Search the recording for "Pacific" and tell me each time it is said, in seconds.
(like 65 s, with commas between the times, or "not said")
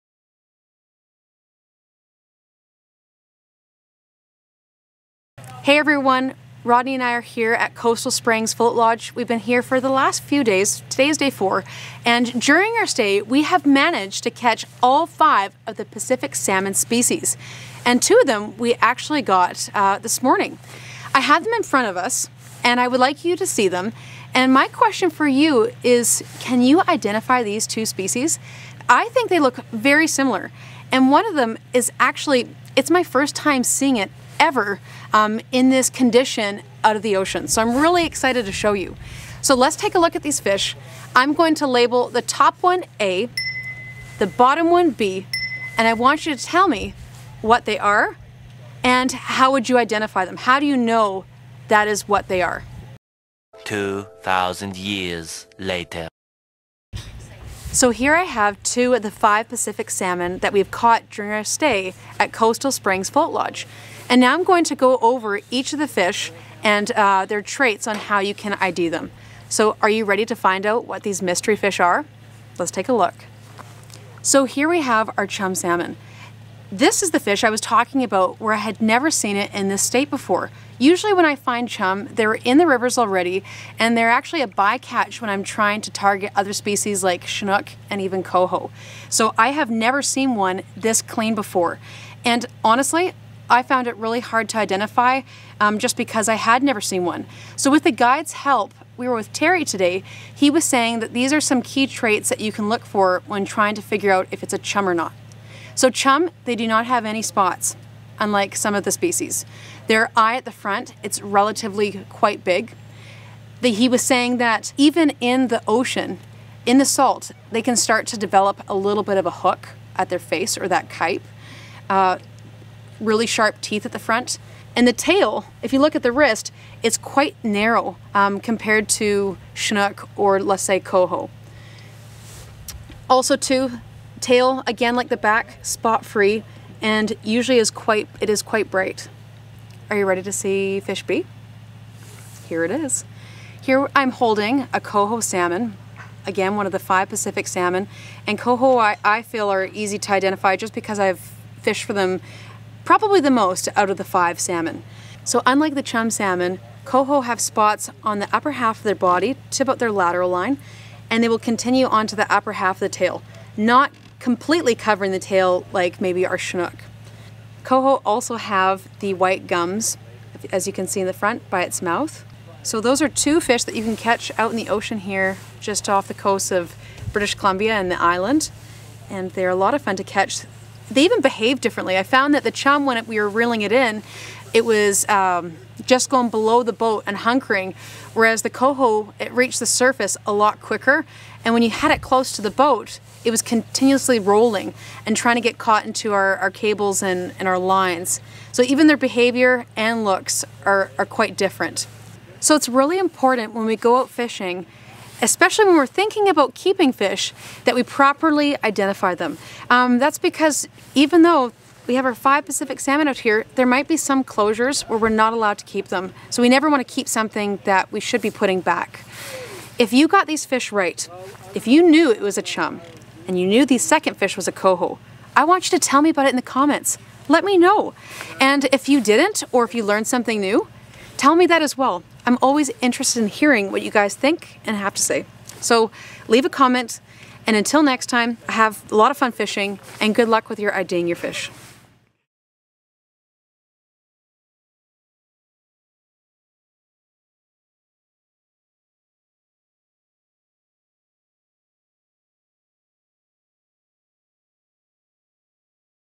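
15 s, 59 s, 147 s, 212 s.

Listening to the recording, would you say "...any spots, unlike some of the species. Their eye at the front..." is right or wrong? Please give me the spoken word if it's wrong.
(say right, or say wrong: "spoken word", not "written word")
right.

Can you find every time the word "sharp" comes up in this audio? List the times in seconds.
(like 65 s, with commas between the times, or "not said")
123 s.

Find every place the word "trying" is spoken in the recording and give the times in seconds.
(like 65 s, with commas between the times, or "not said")
85 s, 103 s, 195 s.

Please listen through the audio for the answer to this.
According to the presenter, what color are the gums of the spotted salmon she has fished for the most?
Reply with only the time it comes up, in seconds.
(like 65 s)
169 s.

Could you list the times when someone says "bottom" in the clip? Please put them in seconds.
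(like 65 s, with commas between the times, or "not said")
44 s.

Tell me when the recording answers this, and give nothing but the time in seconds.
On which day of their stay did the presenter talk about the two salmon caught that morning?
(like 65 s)
11 s.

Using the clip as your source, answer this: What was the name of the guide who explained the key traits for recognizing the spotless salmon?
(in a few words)
Terry.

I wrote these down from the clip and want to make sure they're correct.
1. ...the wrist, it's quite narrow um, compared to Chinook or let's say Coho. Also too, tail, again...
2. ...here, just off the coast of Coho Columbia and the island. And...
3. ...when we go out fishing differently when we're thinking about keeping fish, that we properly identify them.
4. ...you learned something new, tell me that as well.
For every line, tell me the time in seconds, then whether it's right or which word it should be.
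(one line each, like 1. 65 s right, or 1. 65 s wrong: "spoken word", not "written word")
1. 126 s right
2. 174 s wrong: "British", not "Coho"
3. 203 s wrong: "especially", not "differently"
4. 229 s right.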